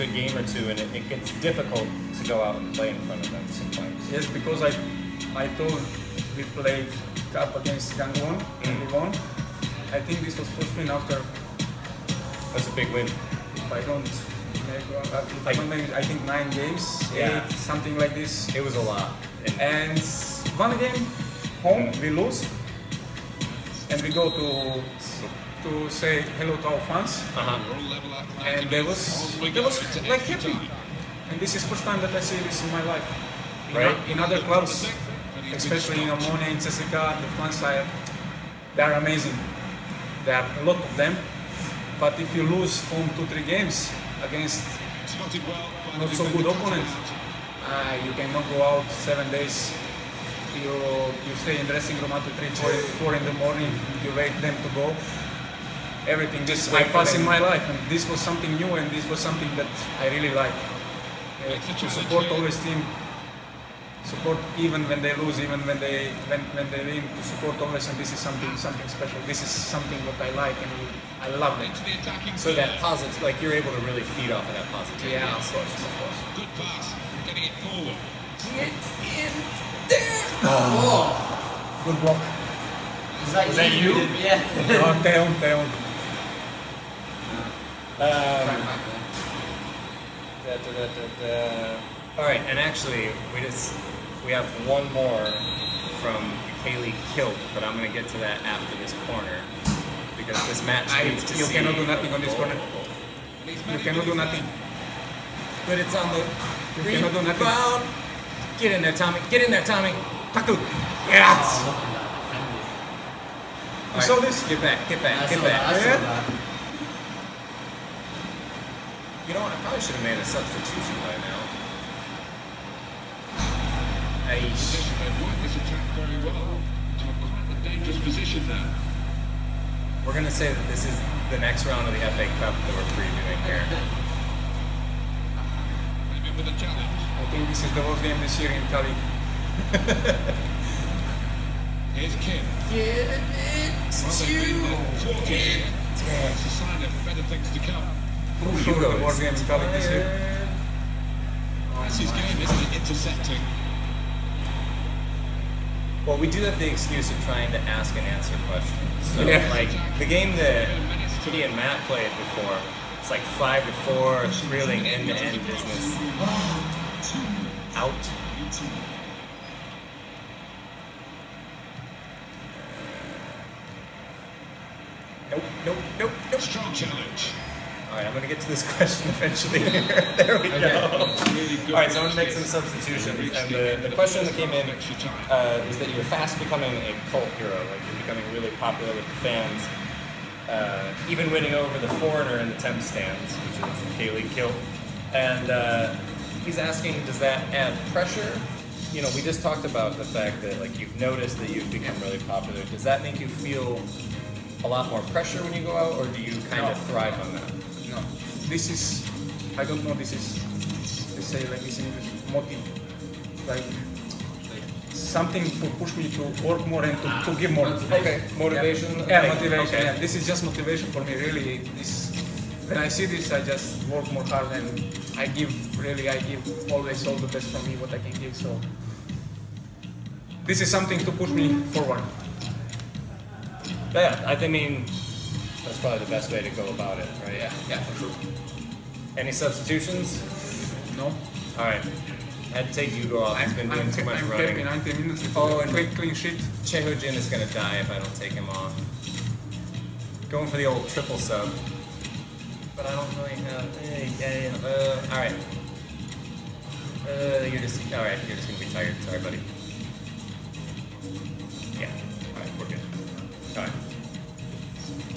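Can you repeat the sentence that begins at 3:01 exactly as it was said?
All right, so I'm going to make some substitutions.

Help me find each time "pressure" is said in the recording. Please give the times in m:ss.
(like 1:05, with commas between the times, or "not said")
3:17, 3:25.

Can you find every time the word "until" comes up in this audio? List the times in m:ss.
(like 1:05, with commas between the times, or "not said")
0:52.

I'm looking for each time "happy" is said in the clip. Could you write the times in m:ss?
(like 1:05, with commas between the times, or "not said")
0:30, 4:04.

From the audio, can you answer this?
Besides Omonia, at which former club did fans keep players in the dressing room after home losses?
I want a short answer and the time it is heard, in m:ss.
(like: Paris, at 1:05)
CSKA, at 0:36.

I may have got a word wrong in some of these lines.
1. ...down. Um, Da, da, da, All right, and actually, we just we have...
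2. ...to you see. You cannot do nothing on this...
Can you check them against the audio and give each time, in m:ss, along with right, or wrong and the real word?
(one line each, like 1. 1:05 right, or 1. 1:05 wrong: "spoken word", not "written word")
1. 1:25 right
2. 1:41 right.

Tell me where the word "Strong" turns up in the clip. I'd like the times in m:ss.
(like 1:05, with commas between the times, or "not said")
2:56.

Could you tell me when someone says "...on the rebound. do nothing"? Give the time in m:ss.
1:45.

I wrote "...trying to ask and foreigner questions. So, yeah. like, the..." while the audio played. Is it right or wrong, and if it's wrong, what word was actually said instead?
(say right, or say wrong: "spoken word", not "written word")
wrong: "answer", not "foreigner".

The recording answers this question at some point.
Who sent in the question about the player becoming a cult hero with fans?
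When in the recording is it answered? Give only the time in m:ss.
3:13.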